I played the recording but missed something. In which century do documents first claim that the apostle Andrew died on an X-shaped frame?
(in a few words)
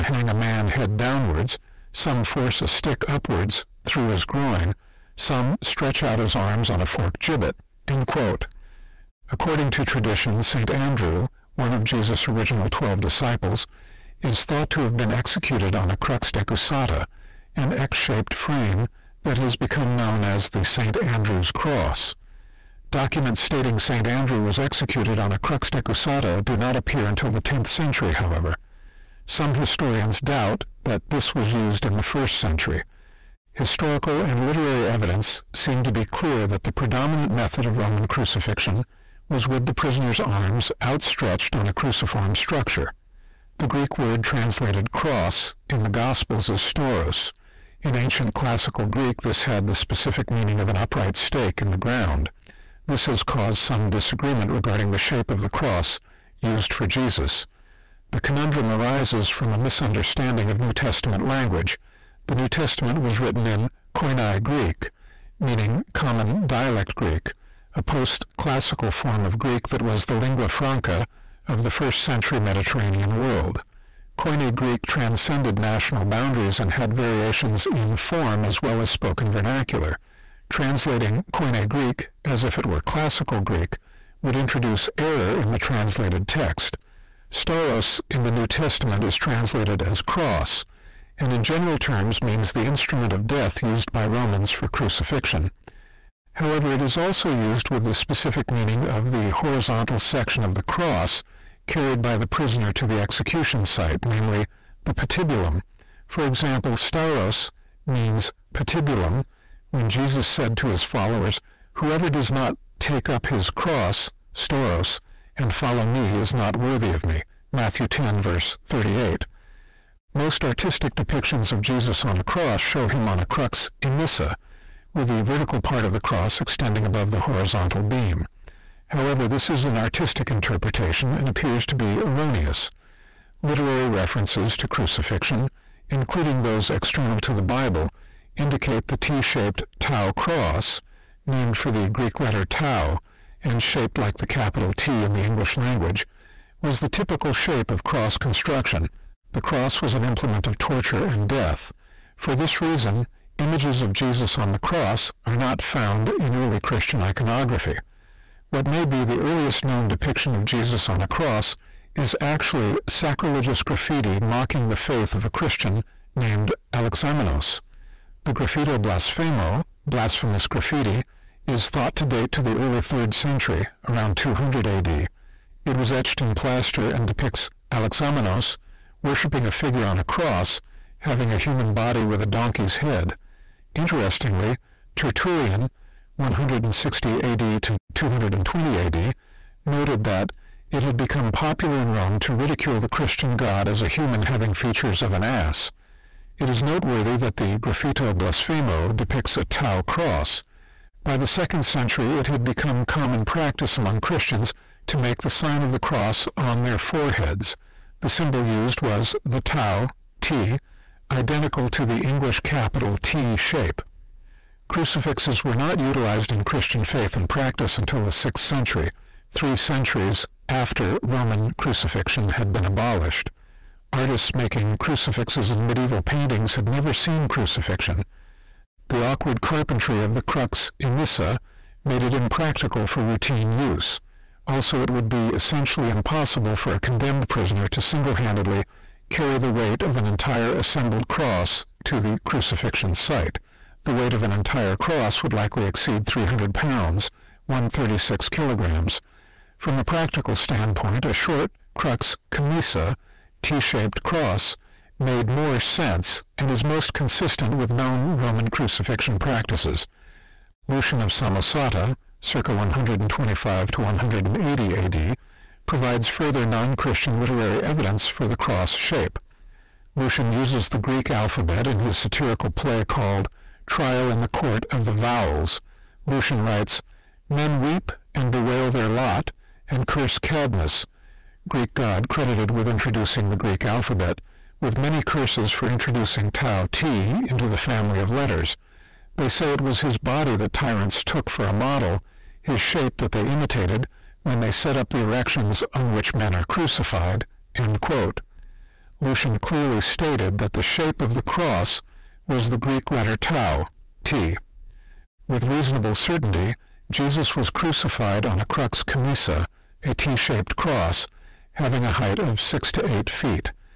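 10th century.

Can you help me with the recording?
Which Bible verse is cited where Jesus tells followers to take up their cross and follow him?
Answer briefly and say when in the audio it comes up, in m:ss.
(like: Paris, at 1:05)
Matthew 10:38, at 1:57.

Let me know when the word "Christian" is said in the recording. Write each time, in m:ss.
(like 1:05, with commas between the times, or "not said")
2:36, 2:45, 3:12, 3:24, 3:36, 4:26.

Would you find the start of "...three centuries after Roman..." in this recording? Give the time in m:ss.
3:39.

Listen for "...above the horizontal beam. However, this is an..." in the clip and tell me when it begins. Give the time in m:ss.
2:06.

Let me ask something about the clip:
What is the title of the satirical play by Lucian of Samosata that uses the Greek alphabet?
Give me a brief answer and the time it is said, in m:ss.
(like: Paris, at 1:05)
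Trial in the Court of the Vowels, at 4:33.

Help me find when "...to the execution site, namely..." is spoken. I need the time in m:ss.
1:42.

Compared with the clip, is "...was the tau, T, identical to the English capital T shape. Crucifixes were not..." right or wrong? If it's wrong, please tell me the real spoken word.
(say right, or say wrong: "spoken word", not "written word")
right.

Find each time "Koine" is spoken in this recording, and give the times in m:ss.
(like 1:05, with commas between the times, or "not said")
1:03, 1:14, 1:21.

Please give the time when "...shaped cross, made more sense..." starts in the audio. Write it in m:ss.
4:13.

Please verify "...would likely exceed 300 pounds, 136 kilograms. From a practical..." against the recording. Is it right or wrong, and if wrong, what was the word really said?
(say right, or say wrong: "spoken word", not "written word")
right.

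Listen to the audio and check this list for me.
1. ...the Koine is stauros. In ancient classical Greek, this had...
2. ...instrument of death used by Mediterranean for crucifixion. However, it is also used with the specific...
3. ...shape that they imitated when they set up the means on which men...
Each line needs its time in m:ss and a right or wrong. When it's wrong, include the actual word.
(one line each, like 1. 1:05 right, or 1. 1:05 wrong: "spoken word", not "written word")
1. 0:45 wrong: "Gospels", not "Koine"
2. 1:32 wrong: "Romans", not "Mediterranean"
3. 4:52 wrong: "erections", not "means".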